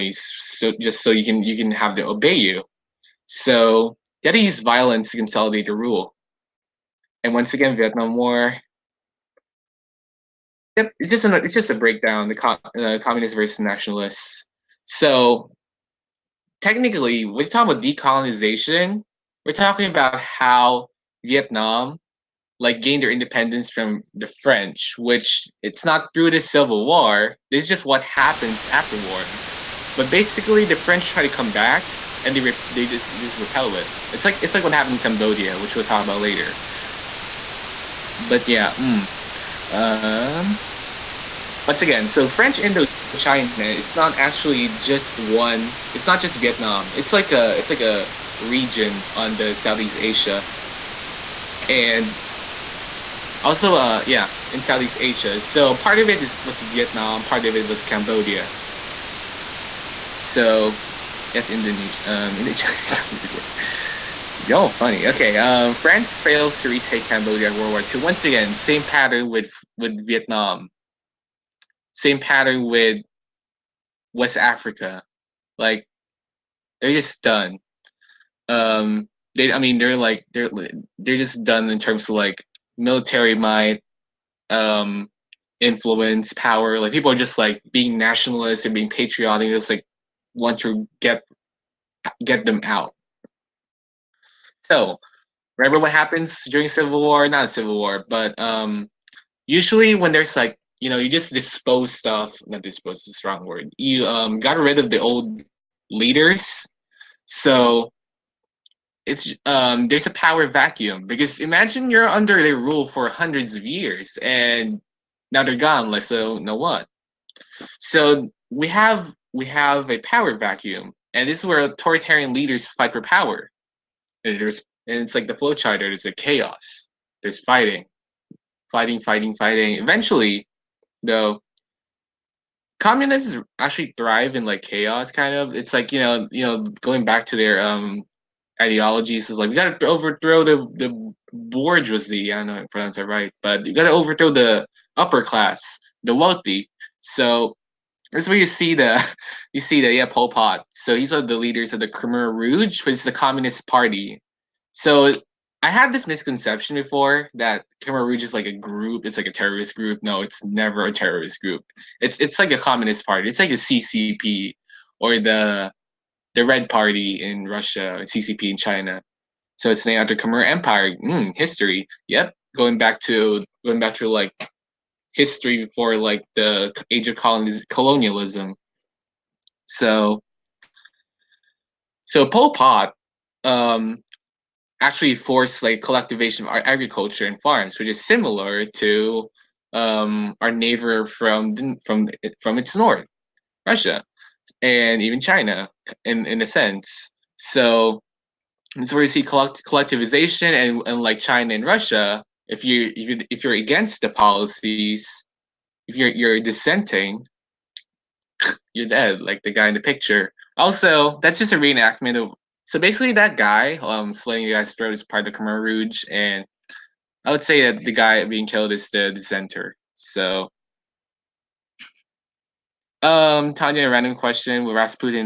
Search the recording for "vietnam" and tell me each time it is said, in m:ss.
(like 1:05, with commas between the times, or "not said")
0:07, 0:21, 0:46, 0:56, 1:10.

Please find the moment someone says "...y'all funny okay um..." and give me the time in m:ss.
1:04.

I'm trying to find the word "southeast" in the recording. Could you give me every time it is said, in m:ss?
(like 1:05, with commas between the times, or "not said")
0:49, 0:54.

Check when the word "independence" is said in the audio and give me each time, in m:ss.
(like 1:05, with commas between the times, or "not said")
0:23.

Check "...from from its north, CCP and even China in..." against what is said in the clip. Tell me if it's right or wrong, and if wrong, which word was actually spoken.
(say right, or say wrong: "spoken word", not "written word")
wrong: "Russia", not "CCP".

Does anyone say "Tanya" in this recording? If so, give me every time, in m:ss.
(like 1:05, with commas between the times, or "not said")
3:43.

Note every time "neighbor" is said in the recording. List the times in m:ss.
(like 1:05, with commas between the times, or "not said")
3:10.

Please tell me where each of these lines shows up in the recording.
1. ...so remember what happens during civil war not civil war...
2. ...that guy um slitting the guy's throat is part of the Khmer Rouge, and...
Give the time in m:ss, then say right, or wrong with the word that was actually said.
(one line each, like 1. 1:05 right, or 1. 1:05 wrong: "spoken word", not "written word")
1. 1:34 right
2. 3:33 right.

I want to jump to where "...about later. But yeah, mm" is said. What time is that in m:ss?
0:36.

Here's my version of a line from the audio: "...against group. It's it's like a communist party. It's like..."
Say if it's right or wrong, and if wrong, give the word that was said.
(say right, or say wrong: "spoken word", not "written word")
wrong: "terrorist", not "against".